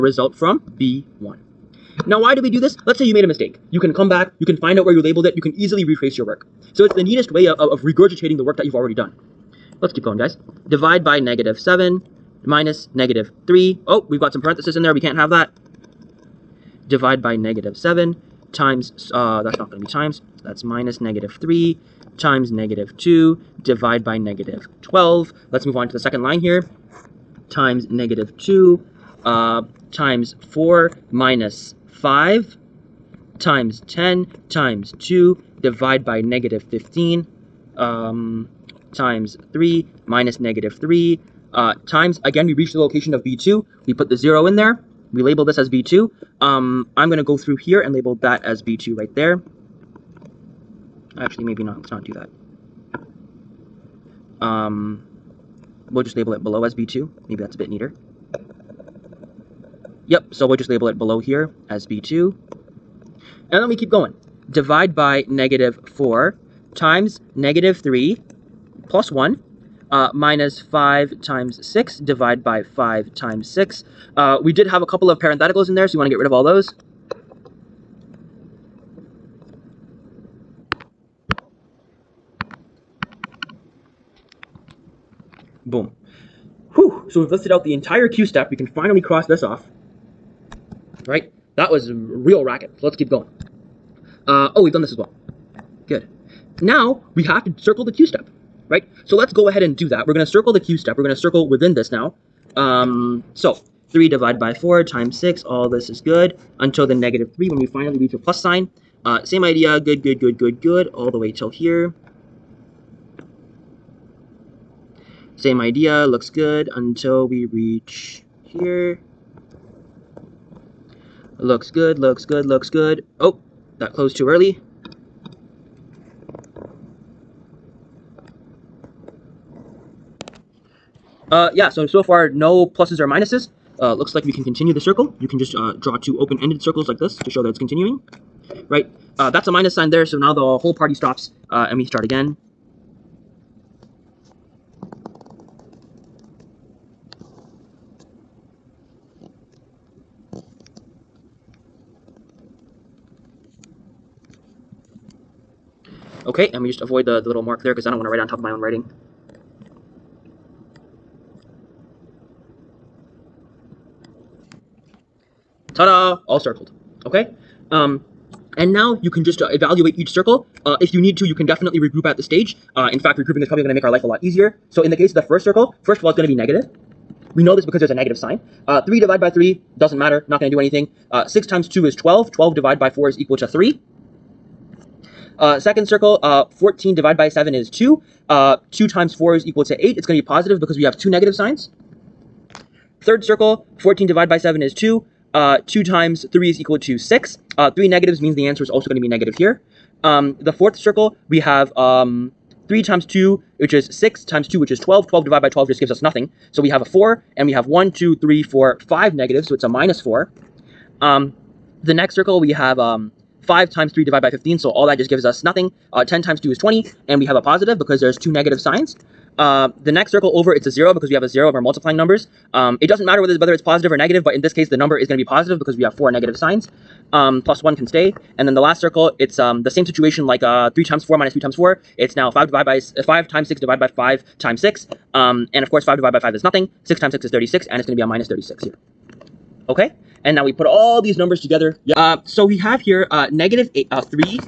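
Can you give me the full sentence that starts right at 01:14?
Uh, we did have a couple of parentheticals in there, so you want to get rid of all those.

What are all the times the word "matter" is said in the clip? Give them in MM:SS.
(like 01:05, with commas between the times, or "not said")
02:59, 03:43.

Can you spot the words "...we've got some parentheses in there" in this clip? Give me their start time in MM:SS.
00:14.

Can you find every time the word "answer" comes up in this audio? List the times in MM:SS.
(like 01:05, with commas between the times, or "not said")
03:18.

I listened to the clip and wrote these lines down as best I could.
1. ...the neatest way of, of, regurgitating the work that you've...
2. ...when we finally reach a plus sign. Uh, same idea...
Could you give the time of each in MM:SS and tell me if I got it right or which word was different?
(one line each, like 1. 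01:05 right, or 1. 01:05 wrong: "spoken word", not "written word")
1. 00:06 right
2. 01:47 right.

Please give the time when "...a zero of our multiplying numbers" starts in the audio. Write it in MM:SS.
03:41.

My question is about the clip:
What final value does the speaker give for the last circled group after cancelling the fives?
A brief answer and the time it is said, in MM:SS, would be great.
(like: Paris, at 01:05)
-36, at 03:58.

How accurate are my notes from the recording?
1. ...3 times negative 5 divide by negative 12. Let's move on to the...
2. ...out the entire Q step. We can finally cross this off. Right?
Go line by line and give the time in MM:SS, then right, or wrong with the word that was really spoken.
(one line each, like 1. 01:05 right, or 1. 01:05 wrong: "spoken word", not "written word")
1. 00:21 wrong: "2", not "5"
2. 01:27 right.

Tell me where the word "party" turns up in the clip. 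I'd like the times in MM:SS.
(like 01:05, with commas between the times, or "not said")
02:20.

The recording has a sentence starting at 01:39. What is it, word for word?
So let's go ahead and do that.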